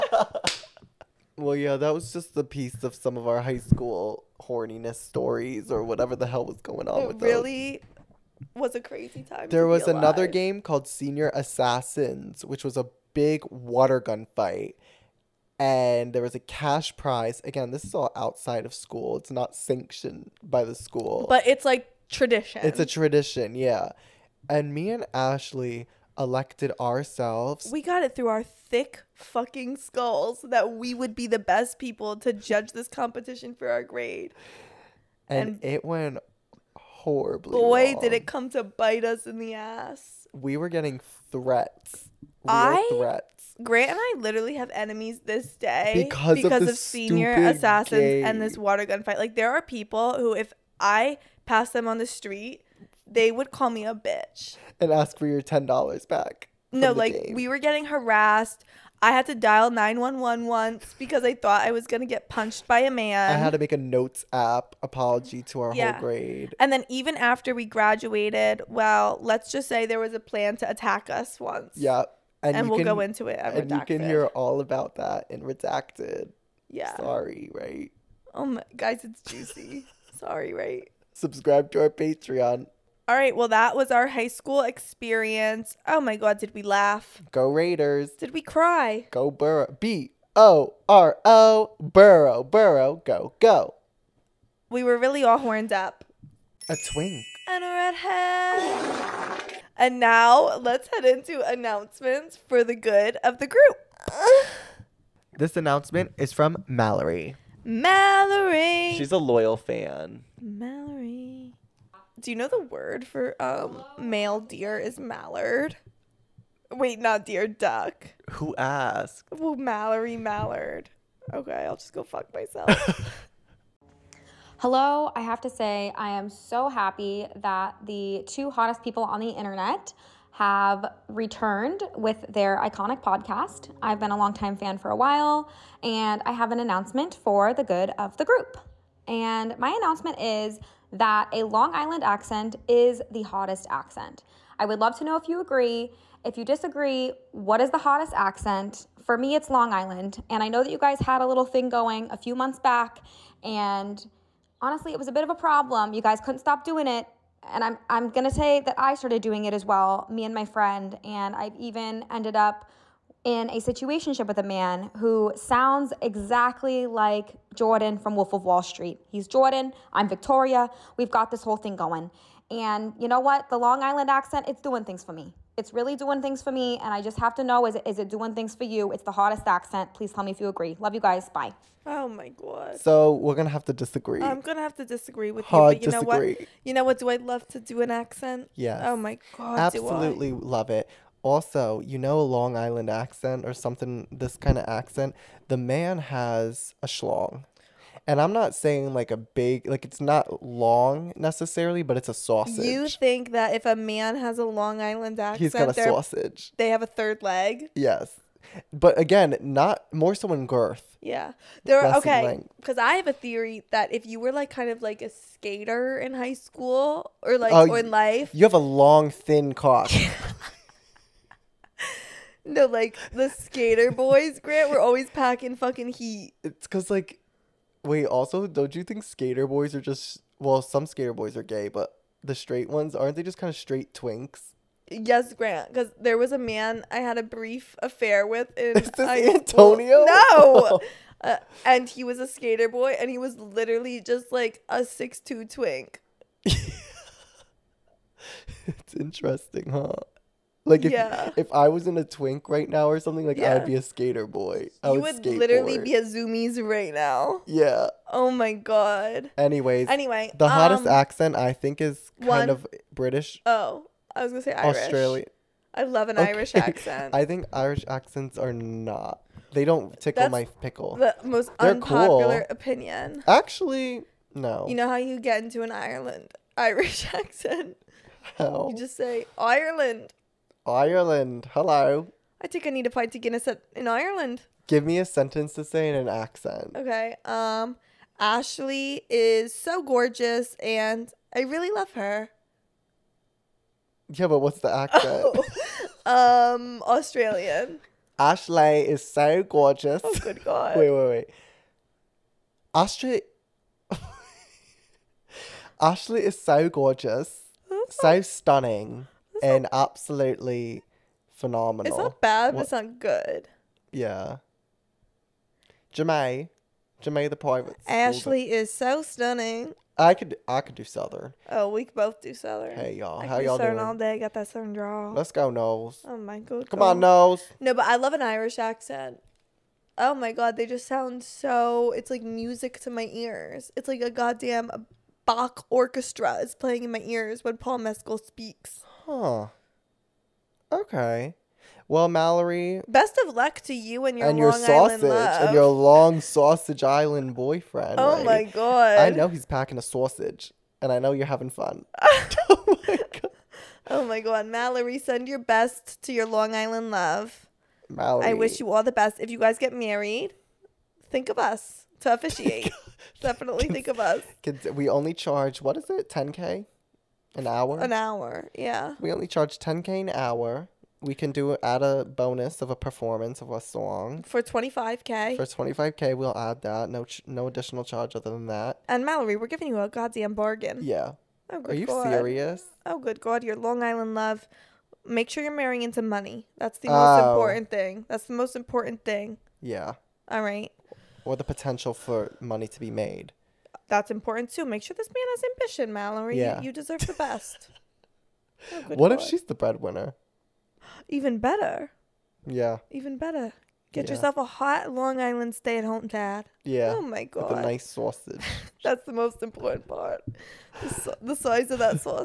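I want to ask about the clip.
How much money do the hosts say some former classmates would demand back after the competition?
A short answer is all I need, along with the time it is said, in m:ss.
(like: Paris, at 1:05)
$10, at 0:55.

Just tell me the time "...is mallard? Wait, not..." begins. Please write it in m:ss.
1:54.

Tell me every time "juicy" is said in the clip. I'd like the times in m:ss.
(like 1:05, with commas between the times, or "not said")
1:19.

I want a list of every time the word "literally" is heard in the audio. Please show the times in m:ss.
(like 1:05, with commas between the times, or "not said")
0:44, 4:03, 4:15.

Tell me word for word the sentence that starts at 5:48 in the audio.
I know he's packing a sausage, and I know you're having fun.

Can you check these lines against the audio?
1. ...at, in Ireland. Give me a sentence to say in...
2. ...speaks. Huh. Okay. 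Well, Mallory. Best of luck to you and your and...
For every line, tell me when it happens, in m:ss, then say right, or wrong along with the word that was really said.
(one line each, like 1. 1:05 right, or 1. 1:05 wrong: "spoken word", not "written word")
1. 4:43 right
2. 5:38 right.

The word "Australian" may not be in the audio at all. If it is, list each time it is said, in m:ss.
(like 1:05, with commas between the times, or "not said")
4:24, 4:56.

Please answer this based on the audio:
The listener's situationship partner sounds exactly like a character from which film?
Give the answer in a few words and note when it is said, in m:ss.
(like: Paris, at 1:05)
Wolf of Wall Street, at 2:48.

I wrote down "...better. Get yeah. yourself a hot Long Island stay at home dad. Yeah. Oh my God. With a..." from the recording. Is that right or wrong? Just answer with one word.
right.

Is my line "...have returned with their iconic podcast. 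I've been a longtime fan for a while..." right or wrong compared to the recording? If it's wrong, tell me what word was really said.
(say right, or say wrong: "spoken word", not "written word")
right.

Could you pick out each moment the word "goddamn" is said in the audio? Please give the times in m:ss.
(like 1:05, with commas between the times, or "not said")
5:34, 6:19.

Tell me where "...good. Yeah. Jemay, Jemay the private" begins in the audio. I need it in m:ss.
5:12.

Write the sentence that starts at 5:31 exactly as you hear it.
It's like music to my ears.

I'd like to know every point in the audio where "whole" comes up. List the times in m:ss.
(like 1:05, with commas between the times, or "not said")
1:05, 2:51.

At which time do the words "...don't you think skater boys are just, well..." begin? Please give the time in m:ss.
3:48.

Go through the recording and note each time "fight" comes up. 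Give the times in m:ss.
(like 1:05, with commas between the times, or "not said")
0:14, 0:49.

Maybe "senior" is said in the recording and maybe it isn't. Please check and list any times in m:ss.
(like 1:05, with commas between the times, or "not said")
0:10, 0:46.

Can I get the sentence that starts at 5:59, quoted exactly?
If you guys get married, think of us to officiate.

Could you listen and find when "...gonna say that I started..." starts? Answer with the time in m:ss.
2:38.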